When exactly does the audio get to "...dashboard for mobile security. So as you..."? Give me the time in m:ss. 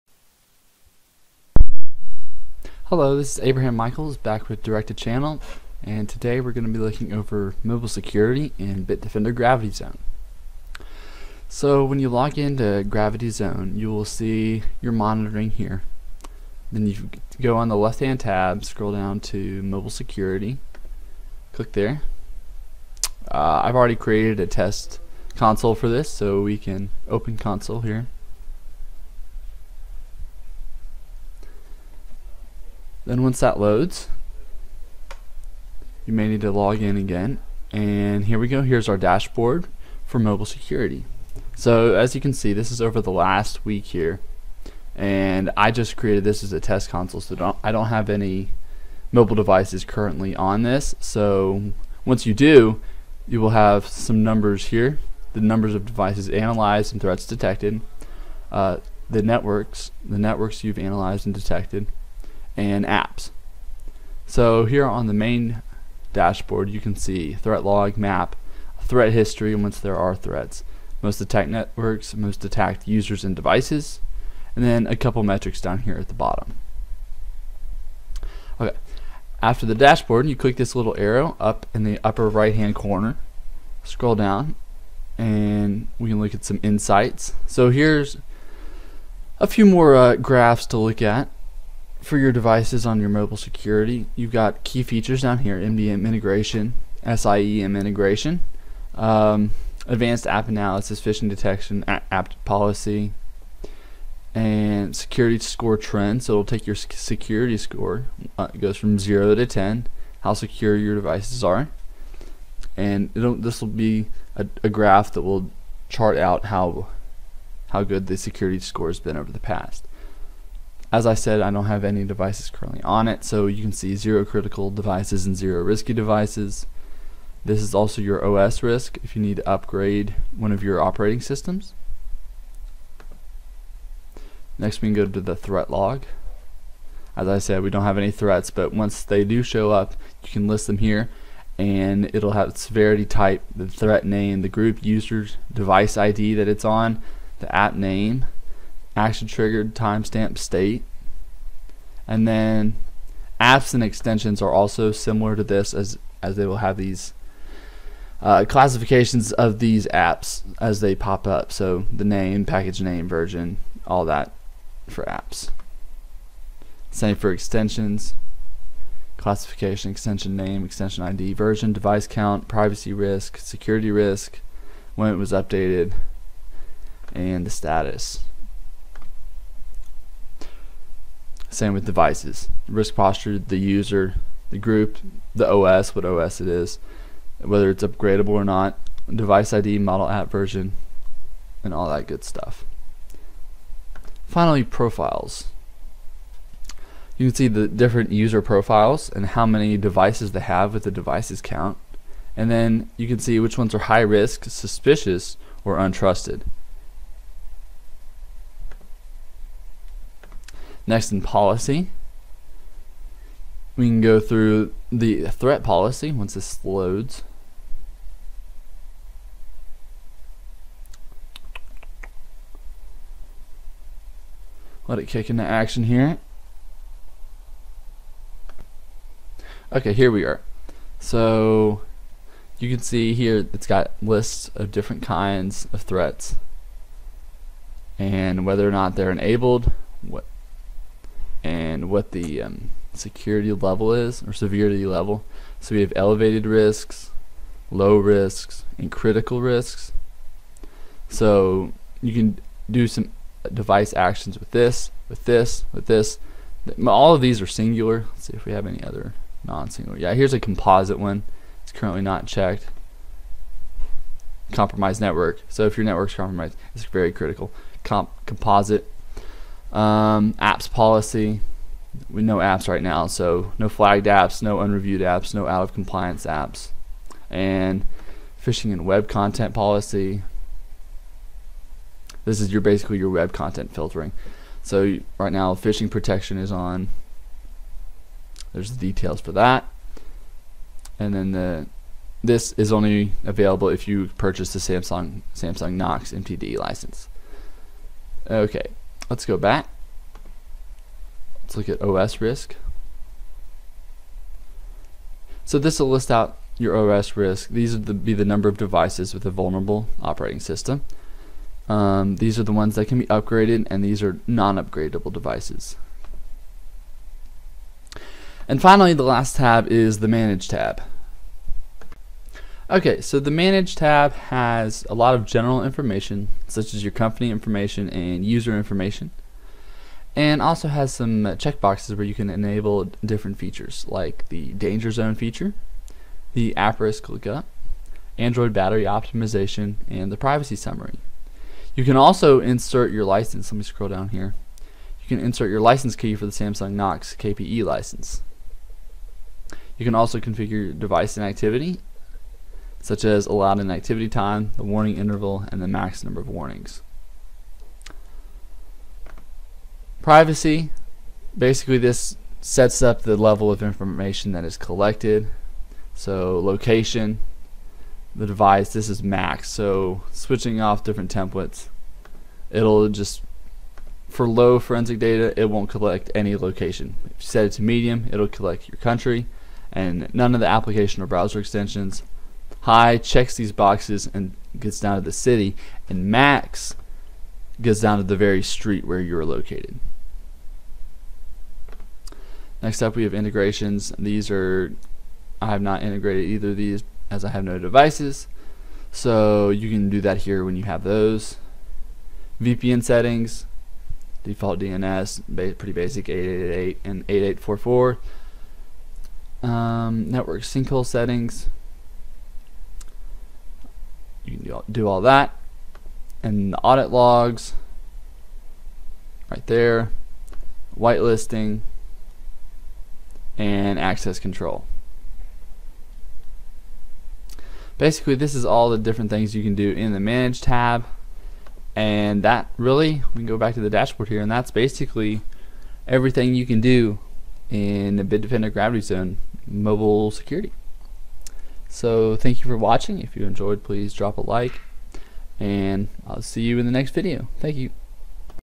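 0:38.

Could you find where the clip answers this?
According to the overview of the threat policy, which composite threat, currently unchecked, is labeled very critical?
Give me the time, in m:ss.
4:24.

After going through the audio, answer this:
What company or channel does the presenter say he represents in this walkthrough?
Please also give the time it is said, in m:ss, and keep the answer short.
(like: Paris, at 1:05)
Direct 2 Channel, at 0:04.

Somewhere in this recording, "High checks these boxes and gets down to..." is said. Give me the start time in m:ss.
6:22.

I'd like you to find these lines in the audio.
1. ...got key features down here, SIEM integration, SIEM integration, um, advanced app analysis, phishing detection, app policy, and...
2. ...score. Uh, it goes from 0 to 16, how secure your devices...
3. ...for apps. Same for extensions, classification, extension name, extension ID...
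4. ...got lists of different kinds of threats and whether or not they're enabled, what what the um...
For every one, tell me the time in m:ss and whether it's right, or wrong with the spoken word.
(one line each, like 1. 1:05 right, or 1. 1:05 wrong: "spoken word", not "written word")
1. 1:34 wrong: "MDM", not "SIEM"
2. 1:47 wrong: "10", not "16"
3. 2:44 right
4. 3:53 right.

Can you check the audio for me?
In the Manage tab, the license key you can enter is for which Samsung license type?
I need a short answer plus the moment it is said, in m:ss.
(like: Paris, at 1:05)
Samsung Knox KPE, at 5:46.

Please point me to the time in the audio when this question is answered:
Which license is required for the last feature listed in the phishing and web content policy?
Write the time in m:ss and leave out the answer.
4:55.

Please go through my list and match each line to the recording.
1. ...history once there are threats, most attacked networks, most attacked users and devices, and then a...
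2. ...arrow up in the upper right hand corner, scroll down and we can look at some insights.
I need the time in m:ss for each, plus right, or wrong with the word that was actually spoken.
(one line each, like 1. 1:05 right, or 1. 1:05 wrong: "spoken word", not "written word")
1. 1:09 right
2. 1:20 right.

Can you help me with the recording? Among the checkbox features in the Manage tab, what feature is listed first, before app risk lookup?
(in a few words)
danger zone.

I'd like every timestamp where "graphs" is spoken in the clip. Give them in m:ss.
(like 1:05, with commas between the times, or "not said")
1:30, 1:54.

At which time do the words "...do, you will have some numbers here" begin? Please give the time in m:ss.
0:52.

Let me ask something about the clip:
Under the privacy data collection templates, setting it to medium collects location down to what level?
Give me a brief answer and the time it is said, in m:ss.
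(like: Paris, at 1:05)
country, at 6:18.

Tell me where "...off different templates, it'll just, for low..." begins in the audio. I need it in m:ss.
6:10.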